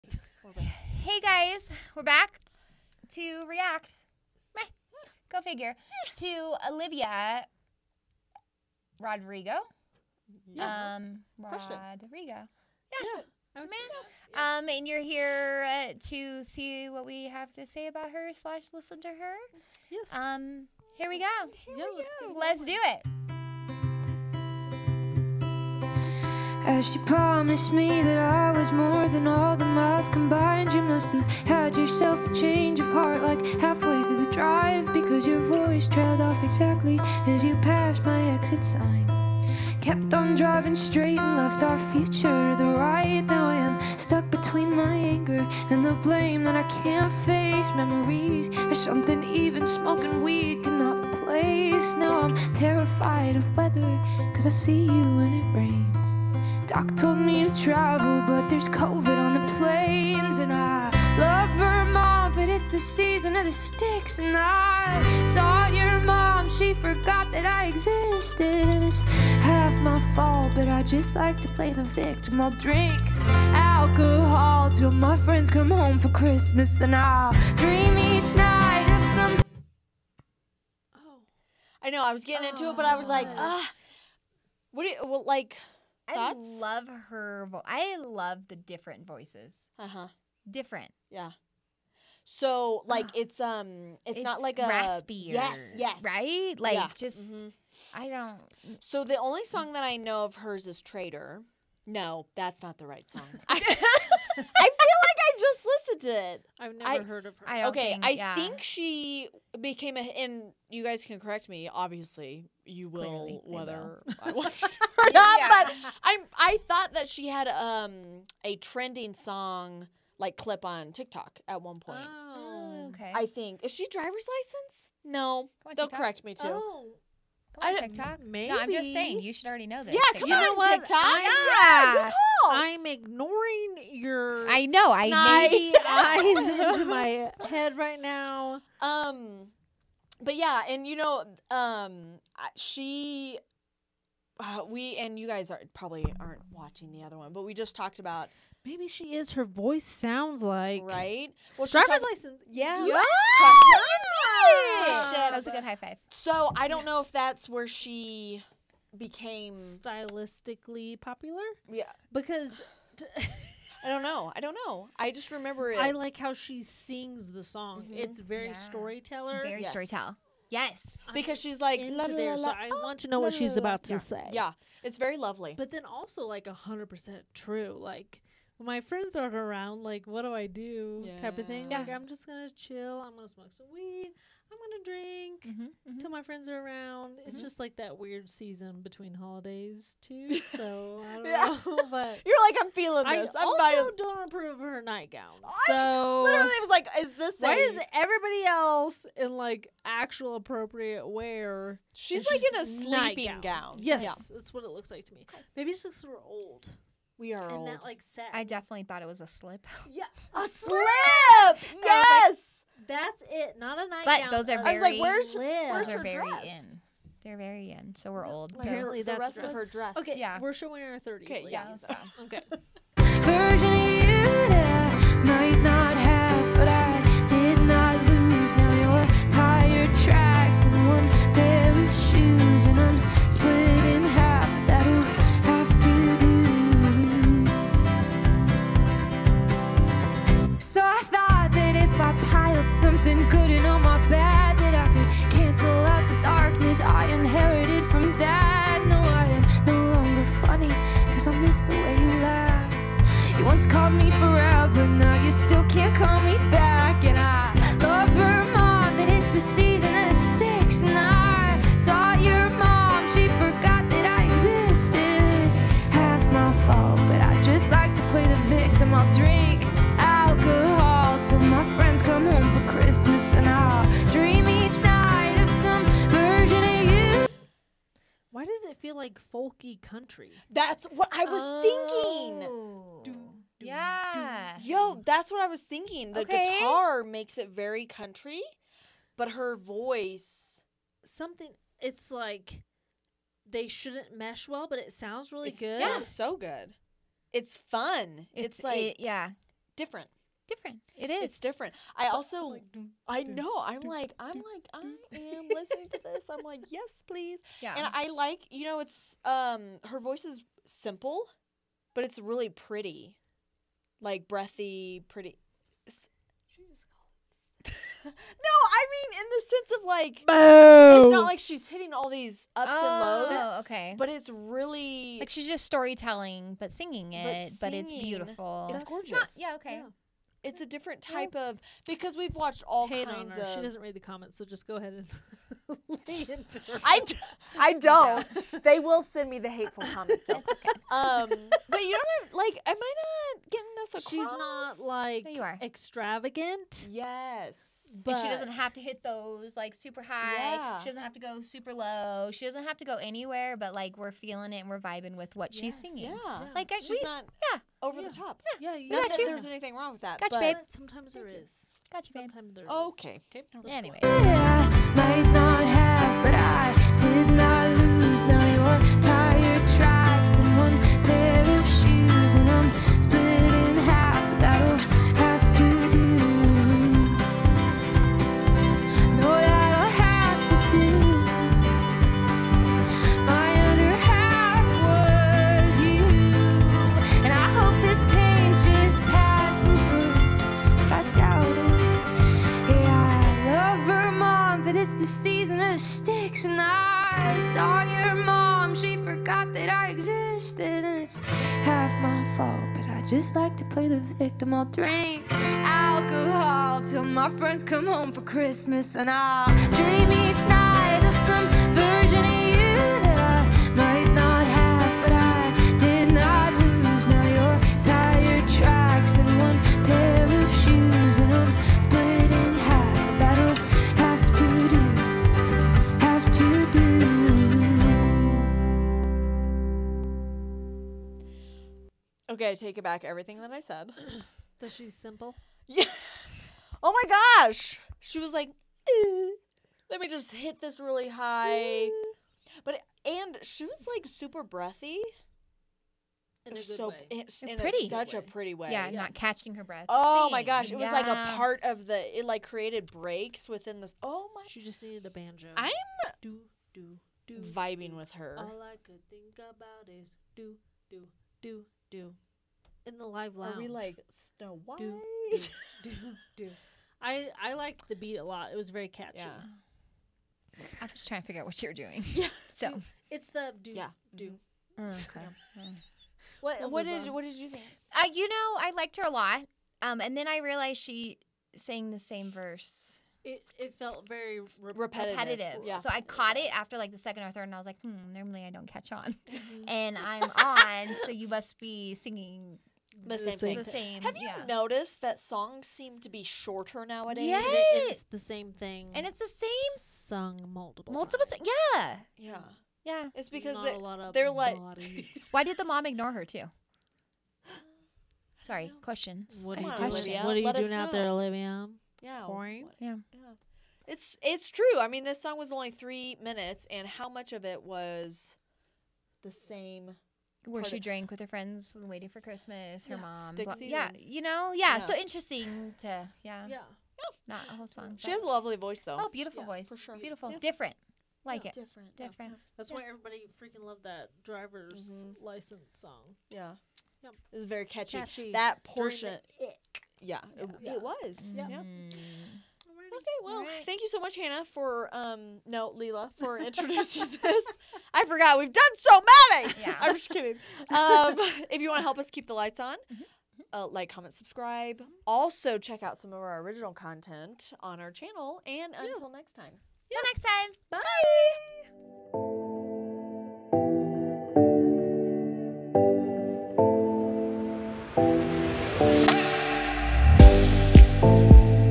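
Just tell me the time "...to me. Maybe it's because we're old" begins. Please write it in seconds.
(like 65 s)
205 s.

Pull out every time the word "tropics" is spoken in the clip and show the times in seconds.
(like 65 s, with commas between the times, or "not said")
not said.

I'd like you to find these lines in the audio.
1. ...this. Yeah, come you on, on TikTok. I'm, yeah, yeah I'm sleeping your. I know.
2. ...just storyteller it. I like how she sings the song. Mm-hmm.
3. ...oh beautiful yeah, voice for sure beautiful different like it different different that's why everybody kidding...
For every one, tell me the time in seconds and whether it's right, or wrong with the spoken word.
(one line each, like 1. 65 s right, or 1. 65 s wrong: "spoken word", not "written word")
1. 129 s wrong: "ignoring", not "sleeping"
2. 165 s wrong: "remember", not "storyteller"
3. 528 s wrong: "freaking", not "kidding".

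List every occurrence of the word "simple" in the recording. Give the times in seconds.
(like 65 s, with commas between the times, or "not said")
310 s, 434 s.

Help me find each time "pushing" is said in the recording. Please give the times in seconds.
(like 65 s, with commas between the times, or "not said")
not said.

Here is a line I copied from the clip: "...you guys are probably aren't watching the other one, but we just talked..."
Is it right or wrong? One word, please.
right.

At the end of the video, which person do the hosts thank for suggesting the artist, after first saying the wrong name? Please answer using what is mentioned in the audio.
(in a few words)
Leela.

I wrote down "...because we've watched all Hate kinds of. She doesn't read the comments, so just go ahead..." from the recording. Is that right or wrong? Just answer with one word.
right.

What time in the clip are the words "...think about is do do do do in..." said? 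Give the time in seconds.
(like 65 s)
459 s.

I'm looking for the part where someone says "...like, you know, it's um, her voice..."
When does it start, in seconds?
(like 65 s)
308 s.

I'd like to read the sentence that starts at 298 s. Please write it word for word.
It's, it's like it, yeah, different different.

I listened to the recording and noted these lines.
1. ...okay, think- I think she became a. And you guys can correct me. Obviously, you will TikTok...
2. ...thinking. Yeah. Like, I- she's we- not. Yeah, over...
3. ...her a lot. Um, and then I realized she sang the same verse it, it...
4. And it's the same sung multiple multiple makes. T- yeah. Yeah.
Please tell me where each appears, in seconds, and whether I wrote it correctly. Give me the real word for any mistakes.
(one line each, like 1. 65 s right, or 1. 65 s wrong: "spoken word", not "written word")
1. 107 s wrong: "Clearly", not "TikTok"
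2. 355 s wrong: "singing", not "thinking"
3. 478 s right
4. 498 s wrong: "times", not "makes".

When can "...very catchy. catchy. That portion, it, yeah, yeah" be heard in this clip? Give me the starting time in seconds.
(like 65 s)
537 s.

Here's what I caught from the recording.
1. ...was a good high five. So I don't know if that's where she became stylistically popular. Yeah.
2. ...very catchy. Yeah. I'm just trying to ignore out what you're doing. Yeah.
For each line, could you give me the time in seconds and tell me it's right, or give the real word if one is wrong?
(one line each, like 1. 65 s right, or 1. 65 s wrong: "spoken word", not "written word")
1. 155 s right
2. 468 s wrong: "figure", not "ignore".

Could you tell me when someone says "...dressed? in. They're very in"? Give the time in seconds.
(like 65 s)
216 s.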